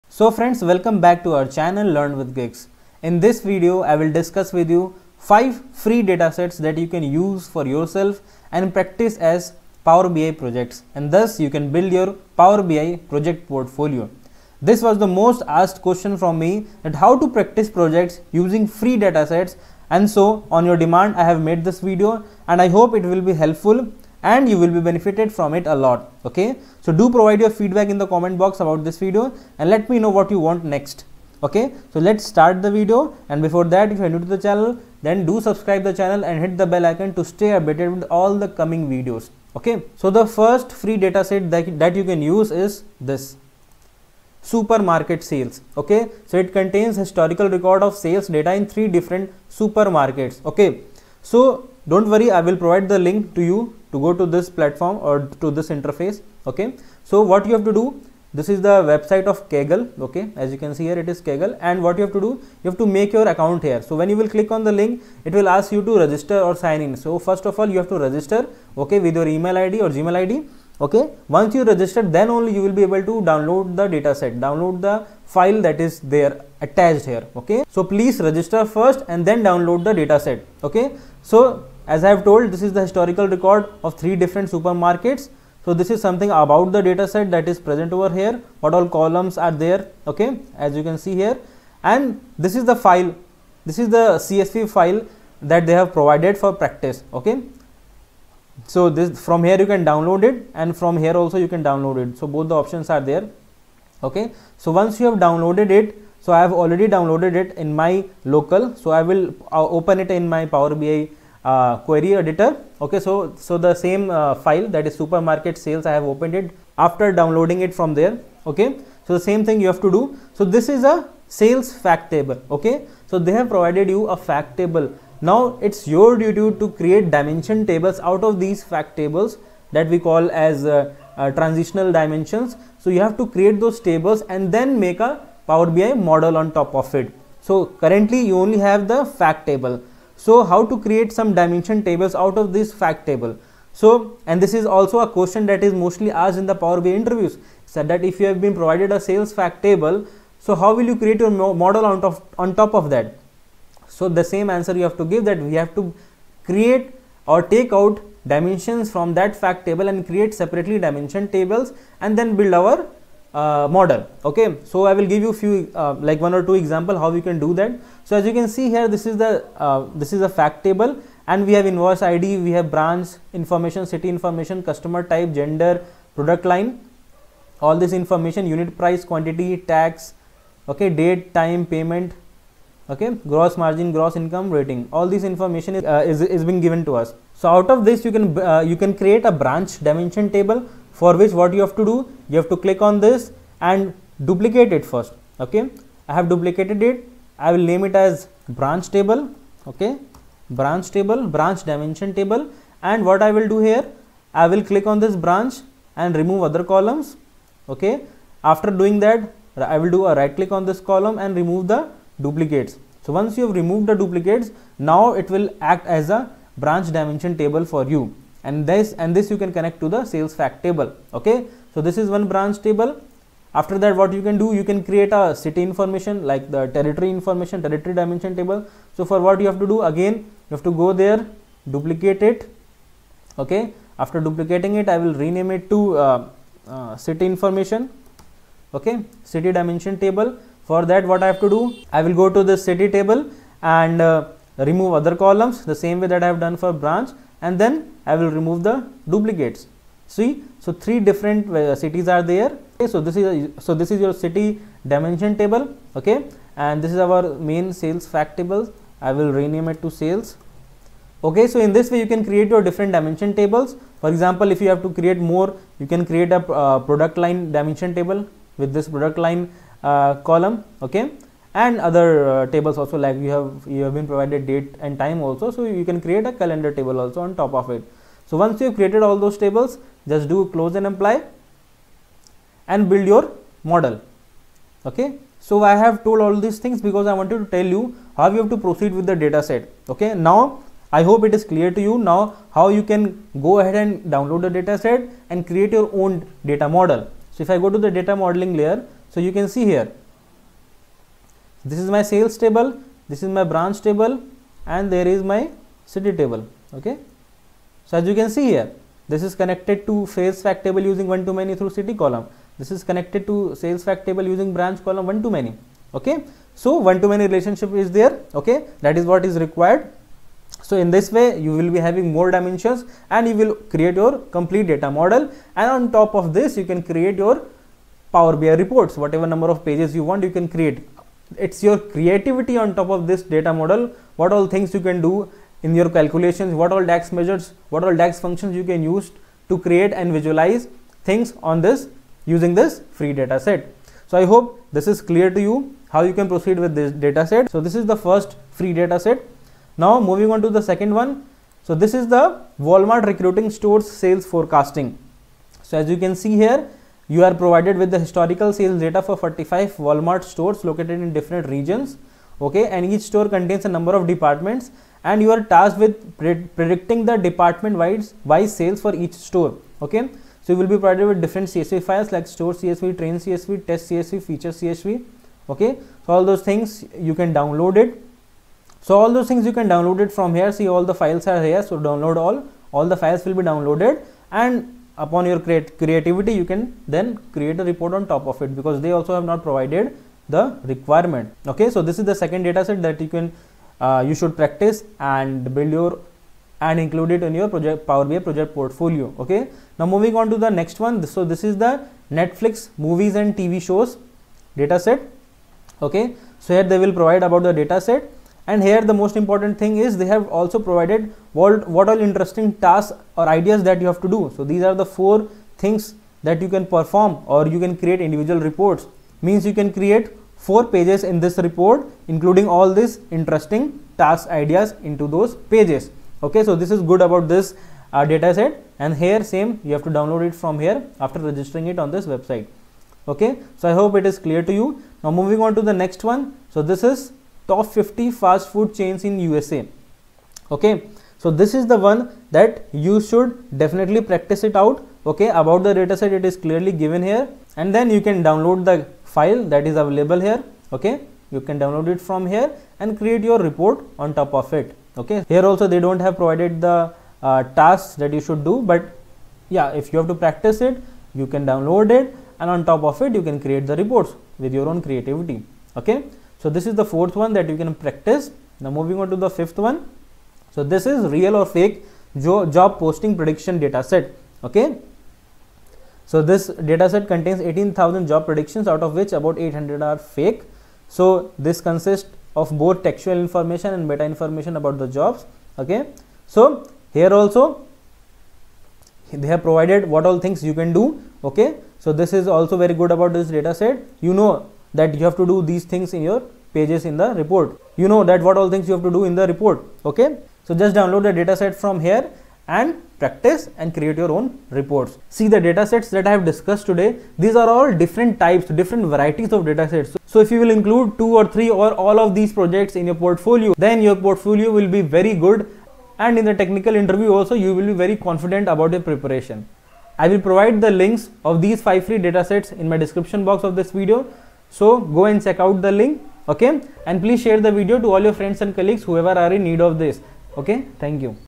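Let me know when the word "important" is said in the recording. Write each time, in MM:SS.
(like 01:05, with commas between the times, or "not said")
06:49.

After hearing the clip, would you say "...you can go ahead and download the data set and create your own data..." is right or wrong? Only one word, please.
right.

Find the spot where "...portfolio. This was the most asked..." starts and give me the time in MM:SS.
00:13.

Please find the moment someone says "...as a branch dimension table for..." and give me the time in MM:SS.
03:35.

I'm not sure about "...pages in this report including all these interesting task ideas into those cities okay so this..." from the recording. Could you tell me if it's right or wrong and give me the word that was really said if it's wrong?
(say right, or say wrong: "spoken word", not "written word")
wrong: "pages", not "cities".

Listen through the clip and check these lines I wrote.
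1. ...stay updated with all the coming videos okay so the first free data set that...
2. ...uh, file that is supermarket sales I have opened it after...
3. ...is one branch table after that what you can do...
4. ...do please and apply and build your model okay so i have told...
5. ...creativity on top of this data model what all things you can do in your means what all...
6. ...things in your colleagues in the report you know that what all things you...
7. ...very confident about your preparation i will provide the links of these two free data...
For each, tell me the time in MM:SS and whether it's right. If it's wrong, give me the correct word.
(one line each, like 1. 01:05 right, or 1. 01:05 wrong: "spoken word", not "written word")
1. 00:37 right
2. 01:54 right
3. 03:41 right
4. 04:40 wrong: "close", not "please"
5. 05:31 wrong: "calculations", not "means"
6. 08:15 wrong: "pages", not "colleagues"
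7. 08:37 wrong: "five", not "two".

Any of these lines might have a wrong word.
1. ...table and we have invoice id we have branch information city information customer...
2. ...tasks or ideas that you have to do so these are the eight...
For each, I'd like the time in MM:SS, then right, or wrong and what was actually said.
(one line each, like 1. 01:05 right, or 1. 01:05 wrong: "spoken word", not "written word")
1. 02:50 right
2. 06:52 wrong: "four", not "eight".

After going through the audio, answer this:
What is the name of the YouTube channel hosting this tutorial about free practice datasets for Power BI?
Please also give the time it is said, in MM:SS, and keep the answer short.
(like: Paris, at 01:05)
Learn with Giggs, at 00:01.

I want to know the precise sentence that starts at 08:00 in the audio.
So this consists of both textual information and meta information about the jobs.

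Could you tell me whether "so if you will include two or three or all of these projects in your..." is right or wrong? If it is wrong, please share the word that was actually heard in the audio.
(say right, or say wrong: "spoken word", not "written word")
right.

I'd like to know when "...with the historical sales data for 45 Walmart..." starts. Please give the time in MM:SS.
05:57.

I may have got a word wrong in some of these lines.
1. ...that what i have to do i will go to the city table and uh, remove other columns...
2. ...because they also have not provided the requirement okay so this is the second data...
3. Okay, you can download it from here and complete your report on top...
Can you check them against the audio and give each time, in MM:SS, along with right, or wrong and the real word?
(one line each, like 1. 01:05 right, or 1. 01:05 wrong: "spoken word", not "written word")
1. 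04:00 right
2. 06:28 right
3. 07:30 wrong: "create", not "complete".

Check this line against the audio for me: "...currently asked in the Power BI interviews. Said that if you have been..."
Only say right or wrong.
wrong.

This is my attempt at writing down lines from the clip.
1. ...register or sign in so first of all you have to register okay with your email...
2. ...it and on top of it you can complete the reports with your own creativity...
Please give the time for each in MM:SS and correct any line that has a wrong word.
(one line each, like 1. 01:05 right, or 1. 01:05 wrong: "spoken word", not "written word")
1. 01:05 right
2. 07:41 wrong: "create", not "complete".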